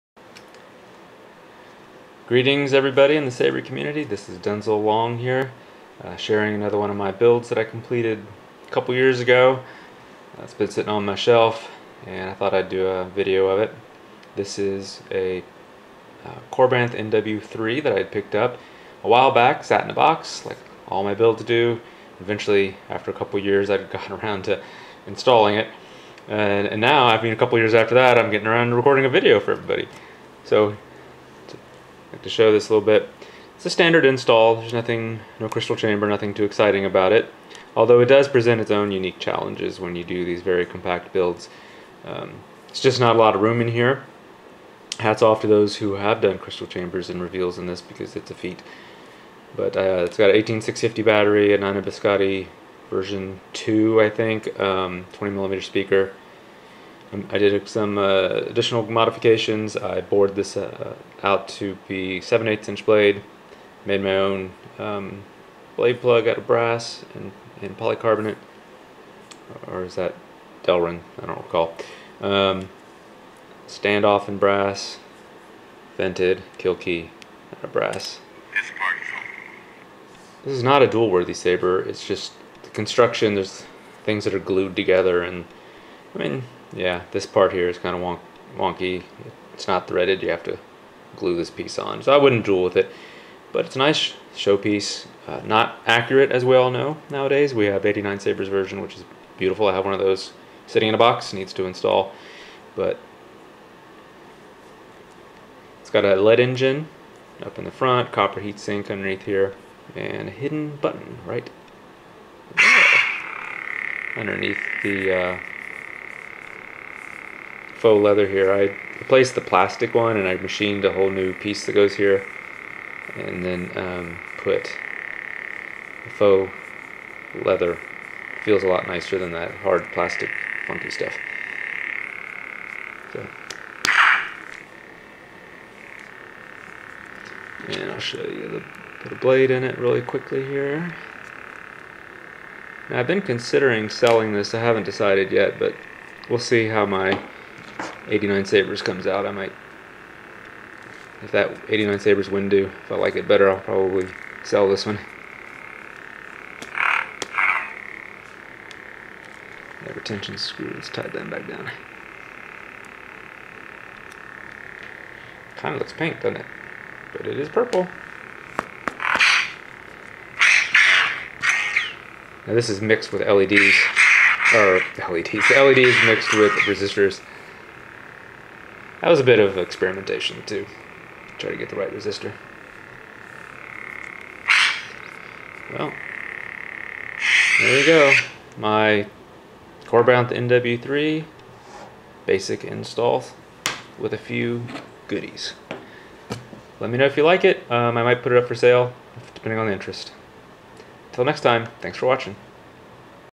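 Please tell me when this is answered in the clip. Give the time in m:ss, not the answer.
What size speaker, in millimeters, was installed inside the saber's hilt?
0:55.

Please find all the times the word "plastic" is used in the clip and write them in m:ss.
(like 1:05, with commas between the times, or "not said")
1:59, 2:09.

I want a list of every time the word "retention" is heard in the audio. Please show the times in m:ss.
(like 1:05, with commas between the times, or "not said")
2:39.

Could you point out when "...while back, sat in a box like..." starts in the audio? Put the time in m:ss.
0:19.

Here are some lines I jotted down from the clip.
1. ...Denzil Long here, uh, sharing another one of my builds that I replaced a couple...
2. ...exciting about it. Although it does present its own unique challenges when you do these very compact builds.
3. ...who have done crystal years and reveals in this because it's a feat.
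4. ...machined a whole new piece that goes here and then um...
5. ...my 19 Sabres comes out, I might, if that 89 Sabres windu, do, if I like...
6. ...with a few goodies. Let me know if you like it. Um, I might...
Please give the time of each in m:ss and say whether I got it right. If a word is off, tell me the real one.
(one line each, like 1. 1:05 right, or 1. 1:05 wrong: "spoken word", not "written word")
1. 0:04 wrong: "completed", not "replaced"
2. 0:36 right
3. 0:45 wrong: "chambers", not "years"
4. 2:00 right
5. 2:26 wrong: "89", not "19"
6. 3:13 right.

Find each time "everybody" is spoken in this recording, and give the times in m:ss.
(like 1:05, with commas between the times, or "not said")
0:02, 0:29.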